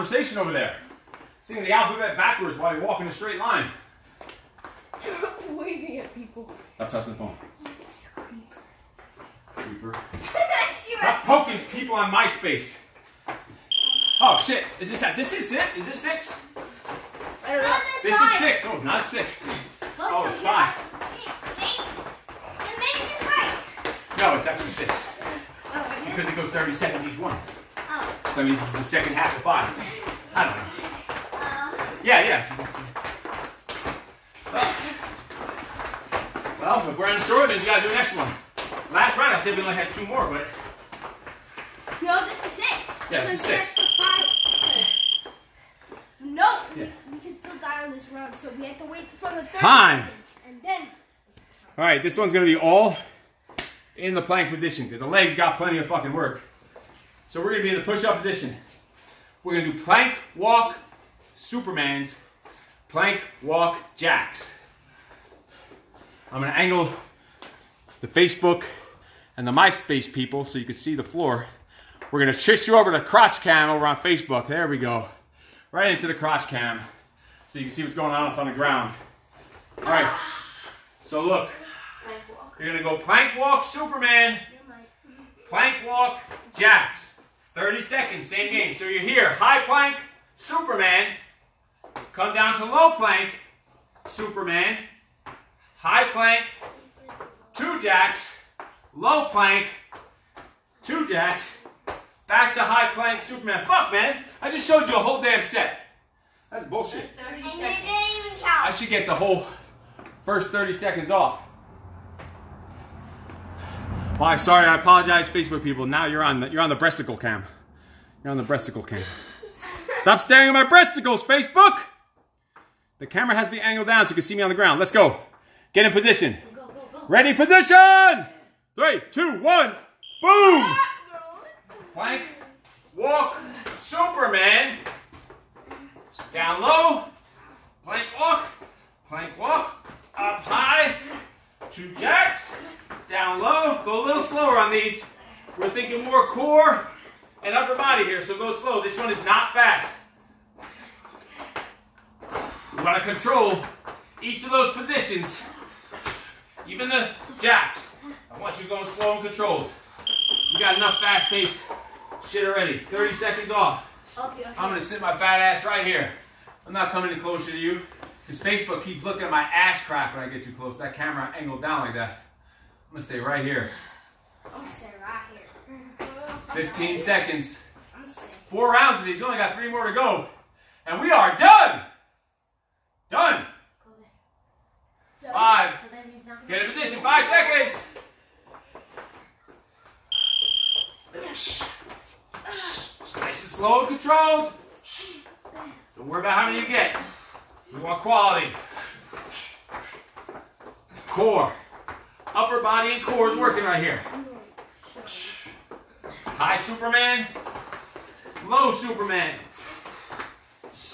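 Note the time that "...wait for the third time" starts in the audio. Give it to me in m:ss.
0:48.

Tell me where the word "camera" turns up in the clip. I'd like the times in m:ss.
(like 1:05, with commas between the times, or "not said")
2:03, 2:50.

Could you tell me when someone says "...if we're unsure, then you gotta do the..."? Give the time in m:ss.
0:36.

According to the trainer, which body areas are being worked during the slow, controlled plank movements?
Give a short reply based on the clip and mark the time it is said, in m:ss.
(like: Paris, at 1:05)
Upper body and core, at 3:22.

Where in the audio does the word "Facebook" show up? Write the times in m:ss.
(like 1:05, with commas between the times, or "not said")
1:08, 1:13, 1:55, 2:01, 2:48.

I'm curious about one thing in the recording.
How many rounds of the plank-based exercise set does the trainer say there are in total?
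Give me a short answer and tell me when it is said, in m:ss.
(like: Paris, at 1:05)
4, at 2:58.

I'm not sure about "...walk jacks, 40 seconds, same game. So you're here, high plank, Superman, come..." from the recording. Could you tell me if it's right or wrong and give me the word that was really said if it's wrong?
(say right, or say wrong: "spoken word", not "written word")
wrong: "30", not "40".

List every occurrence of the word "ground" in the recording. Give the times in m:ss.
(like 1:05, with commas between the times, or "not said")
1:18, 2:04.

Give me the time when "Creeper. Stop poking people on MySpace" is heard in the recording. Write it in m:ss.
0:09.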